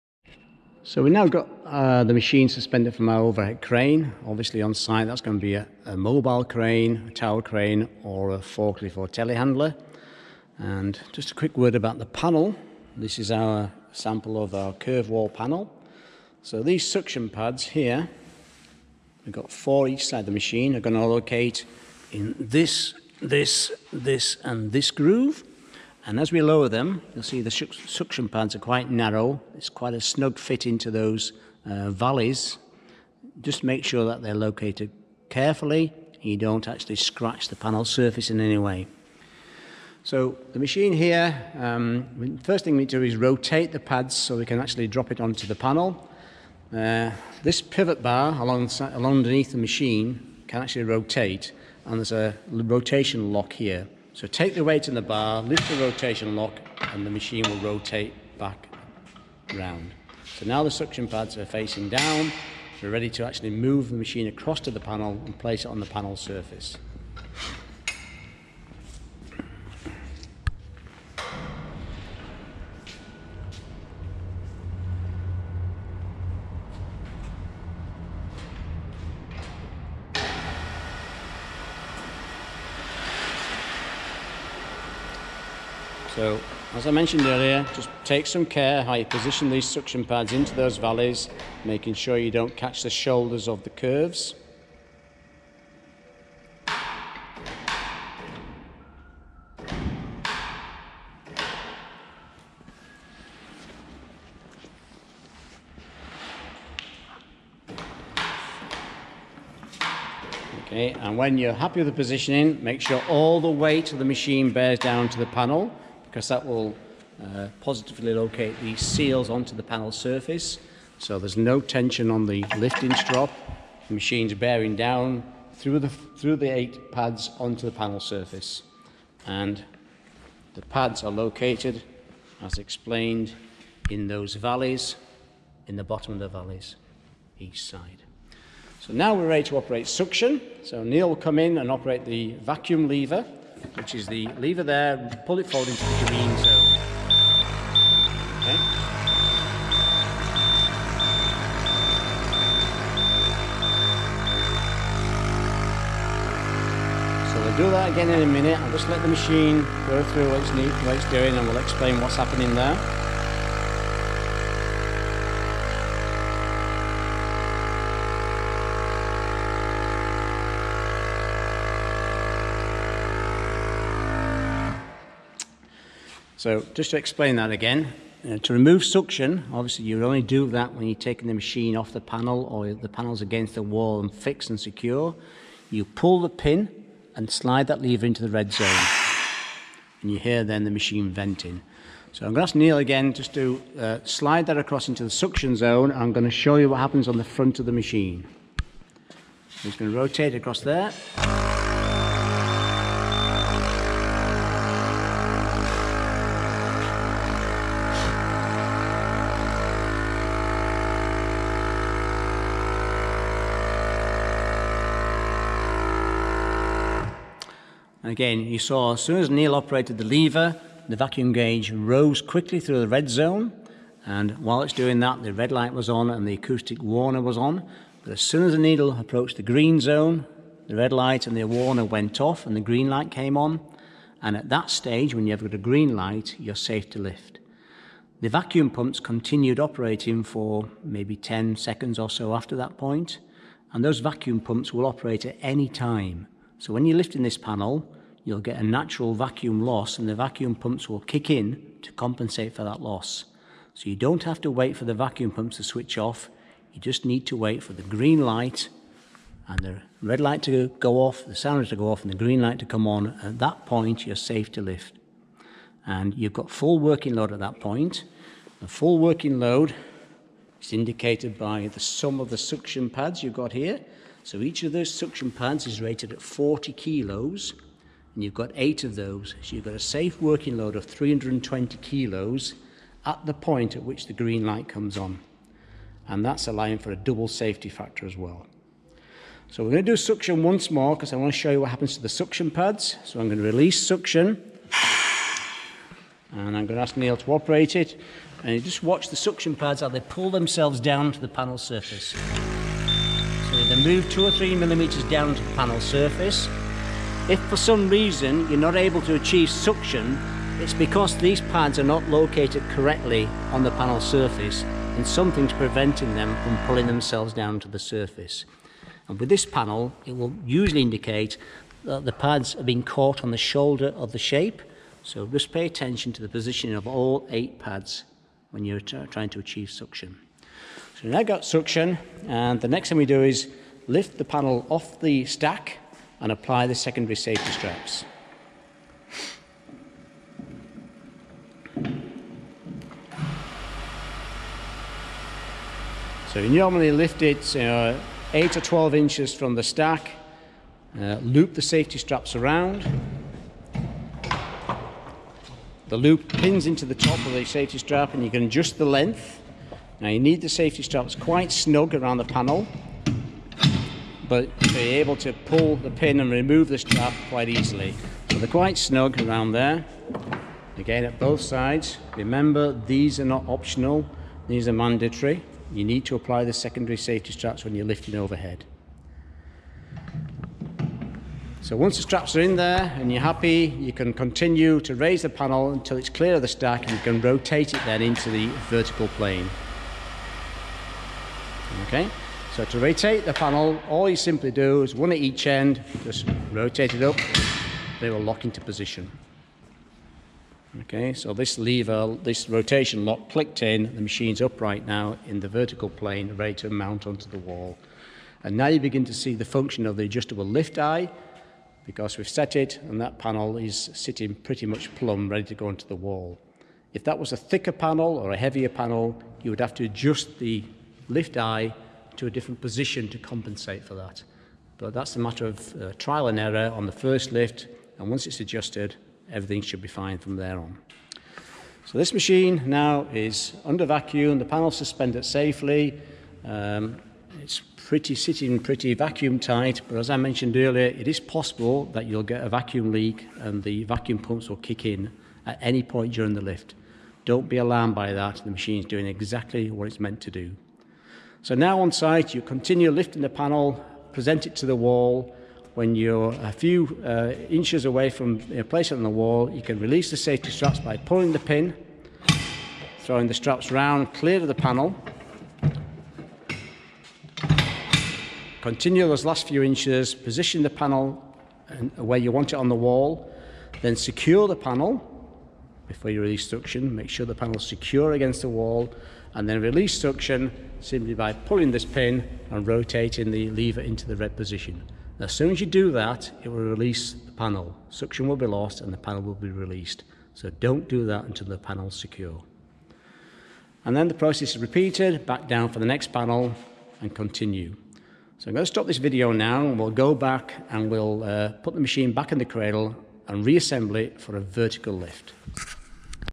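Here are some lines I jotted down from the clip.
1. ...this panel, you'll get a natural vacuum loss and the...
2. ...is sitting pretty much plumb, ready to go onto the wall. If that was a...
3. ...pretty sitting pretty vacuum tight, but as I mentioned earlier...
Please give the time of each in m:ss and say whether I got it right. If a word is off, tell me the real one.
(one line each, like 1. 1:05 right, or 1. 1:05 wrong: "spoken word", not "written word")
1. 4:07 right
2. 6:53 right
3. 7:17 right.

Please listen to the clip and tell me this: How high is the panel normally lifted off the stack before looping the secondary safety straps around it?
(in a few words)
8 or 12 inches.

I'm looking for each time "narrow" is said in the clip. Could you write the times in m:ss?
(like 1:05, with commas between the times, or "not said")
0:28.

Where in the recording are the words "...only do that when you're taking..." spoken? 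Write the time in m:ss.
3:00.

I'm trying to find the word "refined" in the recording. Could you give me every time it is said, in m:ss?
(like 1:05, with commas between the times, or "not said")
not said.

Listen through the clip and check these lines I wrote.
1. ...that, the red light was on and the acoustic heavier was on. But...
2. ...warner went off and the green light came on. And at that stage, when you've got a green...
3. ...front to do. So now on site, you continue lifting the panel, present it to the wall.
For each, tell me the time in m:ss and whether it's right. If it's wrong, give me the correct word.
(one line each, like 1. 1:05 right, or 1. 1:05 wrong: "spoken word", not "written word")
1. 3:44 wrong: "warner", not "heavier"
2. 3:51 right
3. 7:29 wrong: "meant", not "front".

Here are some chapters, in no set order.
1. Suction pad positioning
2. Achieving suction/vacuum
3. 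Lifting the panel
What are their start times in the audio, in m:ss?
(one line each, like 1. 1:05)
1. 1:26
2. 2:20
3. 5:50.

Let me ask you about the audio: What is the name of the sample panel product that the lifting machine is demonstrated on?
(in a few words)
Curvewall.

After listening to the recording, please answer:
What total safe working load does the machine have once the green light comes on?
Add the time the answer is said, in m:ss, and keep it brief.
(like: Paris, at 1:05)
320 kilos, at 4:40.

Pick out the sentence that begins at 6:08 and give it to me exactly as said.
So they're quite snug around there.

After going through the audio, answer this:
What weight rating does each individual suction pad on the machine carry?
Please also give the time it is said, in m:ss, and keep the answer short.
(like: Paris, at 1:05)
40 kilos, at 4:36.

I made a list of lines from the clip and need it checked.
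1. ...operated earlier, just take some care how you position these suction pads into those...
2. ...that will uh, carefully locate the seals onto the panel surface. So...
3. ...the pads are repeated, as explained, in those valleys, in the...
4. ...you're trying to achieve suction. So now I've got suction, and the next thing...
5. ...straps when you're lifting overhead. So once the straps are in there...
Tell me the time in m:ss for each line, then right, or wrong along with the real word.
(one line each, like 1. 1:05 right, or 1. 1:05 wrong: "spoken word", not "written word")
1. 1:26 wrong: "mentioned", not "operated"
2. 1:56 wrong: "positively", not "carefully"
3. 2:10 wrong: "located", not "repeated"
4. 5:28 right
5. 6:17 right.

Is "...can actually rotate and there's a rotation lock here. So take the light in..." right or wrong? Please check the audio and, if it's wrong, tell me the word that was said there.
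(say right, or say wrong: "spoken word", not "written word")
wrong: "weight", not "light".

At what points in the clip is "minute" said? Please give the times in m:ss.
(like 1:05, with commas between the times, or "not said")
2:38.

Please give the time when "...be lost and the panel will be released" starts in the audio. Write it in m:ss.
8:08.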